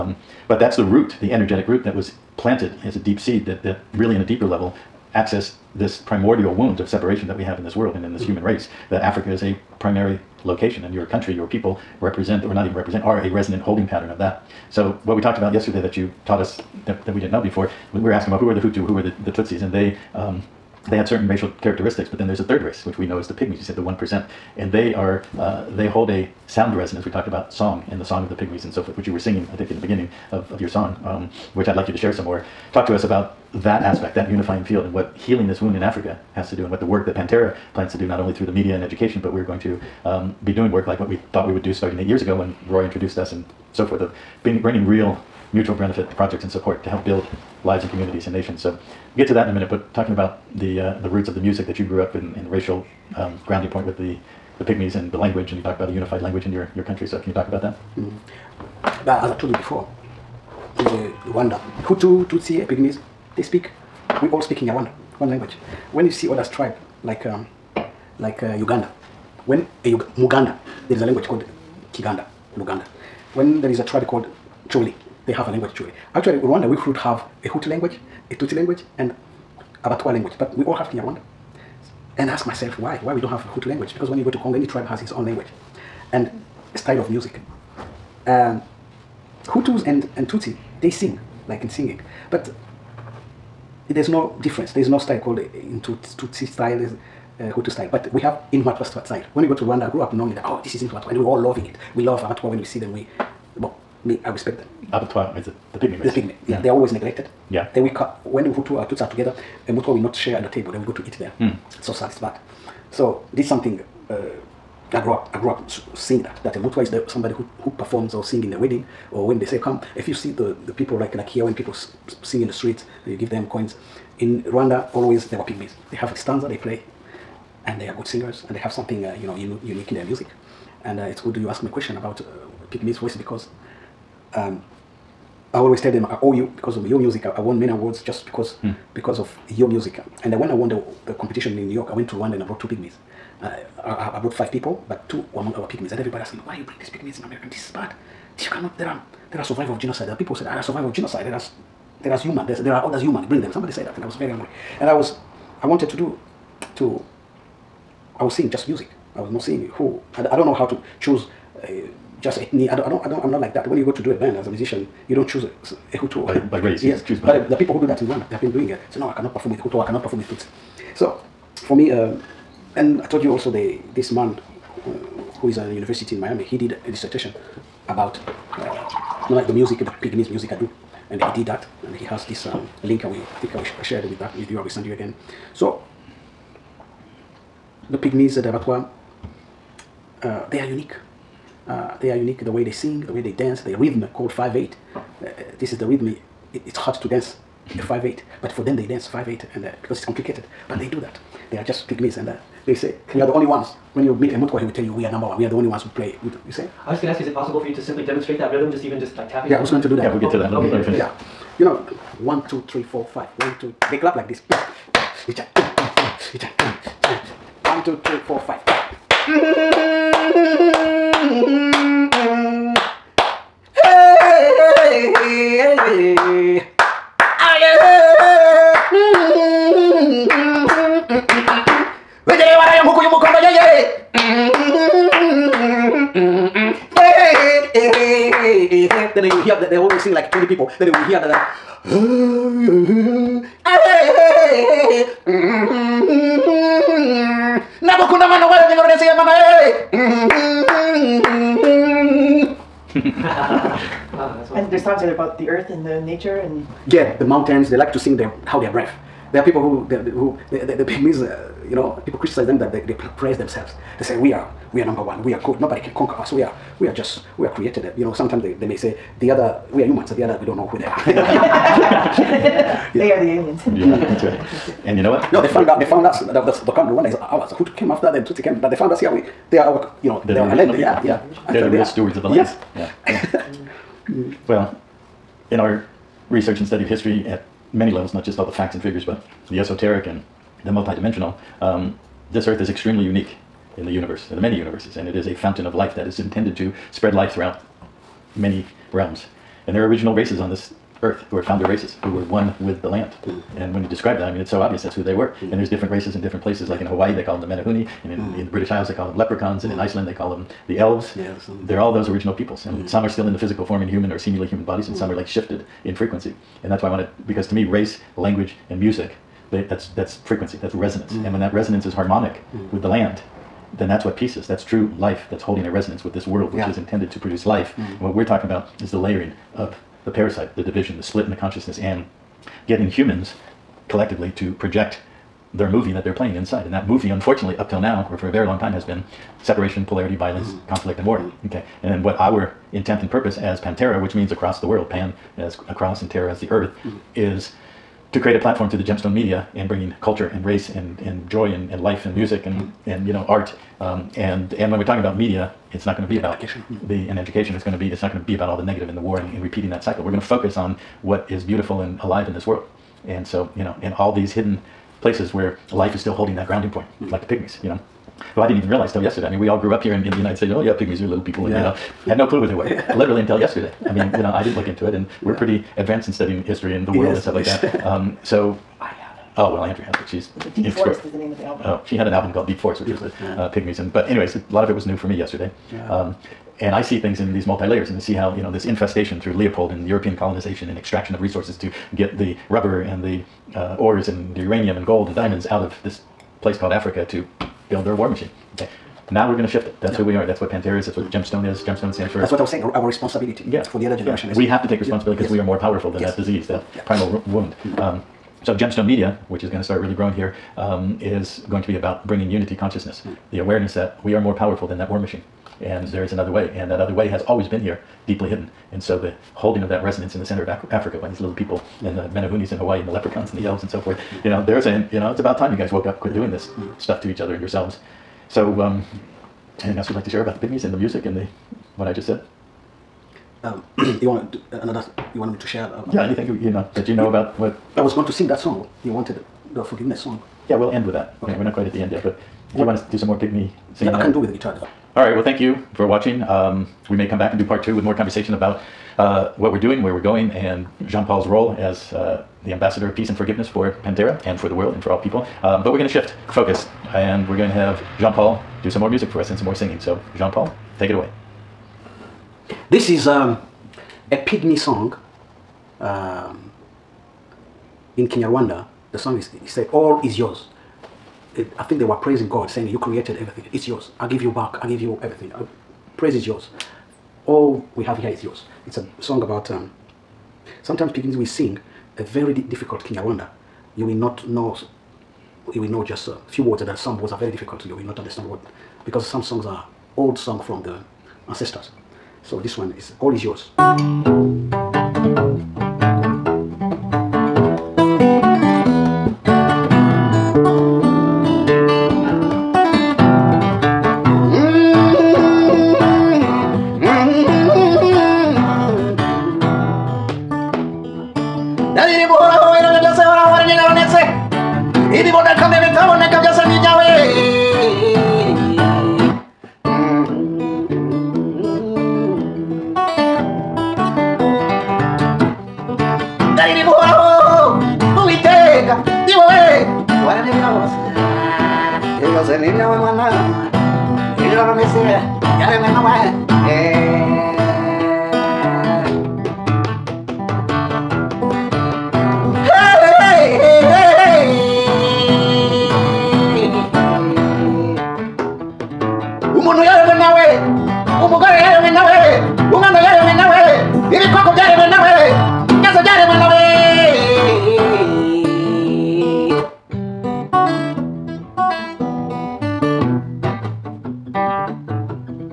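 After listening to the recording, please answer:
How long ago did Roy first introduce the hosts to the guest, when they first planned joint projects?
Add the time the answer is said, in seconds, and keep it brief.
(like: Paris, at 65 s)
8 years, at 41 s.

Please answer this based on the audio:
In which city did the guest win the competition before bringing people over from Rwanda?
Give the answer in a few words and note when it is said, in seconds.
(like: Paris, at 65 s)
New York, at 141 s.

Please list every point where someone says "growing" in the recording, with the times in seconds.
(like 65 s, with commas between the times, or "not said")
409 s.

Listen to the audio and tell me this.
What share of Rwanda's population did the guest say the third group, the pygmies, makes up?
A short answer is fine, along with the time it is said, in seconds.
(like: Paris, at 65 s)
1 percent, at 23 s.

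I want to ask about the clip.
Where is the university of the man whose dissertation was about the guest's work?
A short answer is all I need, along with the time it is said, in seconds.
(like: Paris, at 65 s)
Miami, at 176 s.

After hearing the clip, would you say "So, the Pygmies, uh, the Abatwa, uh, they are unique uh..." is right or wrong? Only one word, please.
right.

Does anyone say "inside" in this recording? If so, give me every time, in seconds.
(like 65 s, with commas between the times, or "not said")
336 s.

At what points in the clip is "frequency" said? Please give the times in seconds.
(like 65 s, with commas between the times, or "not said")
315 s, 320 s.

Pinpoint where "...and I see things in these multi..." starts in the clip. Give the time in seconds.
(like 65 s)
386 s.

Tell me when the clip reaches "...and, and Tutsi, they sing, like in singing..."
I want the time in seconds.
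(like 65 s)
89 s.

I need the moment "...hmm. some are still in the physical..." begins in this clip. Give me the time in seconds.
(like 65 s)
312 s.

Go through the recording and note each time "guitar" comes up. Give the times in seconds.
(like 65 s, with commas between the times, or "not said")
444 s.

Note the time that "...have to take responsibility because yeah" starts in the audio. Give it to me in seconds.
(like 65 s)
404 s.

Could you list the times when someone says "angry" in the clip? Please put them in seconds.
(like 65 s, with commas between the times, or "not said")
154 s.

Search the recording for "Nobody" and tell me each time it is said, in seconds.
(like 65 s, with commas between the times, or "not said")
265 s.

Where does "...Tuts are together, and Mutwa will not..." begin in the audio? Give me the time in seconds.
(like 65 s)
108 s.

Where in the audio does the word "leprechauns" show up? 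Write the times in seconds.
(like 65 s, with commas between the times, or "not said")
309 s, 422 s.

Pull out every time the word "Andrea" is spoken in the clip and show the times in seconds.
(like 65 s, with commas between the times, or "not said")
379 s.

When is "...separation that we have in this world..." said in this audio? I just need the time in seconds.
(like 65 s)
6 s.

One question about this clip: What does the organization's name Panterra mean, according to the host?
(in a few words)
Across the world.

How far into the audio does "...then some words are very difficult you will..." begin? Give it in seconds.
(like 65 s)
486 s.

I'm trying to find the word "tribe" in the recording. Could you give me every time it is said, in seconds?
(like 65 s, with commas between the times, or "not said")
66 s, 73 s, 84 s.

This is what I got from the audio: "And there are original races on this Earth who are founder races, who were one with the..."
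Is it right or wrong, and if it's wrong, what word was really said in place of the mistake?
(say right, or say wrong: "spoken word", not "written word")
right.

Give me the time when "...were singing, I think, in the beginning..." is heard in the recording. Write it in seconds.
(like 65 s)
29 s.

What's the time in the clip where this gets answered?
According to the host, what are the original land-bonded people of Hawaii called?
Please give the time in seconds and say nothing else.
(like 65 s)
307 s.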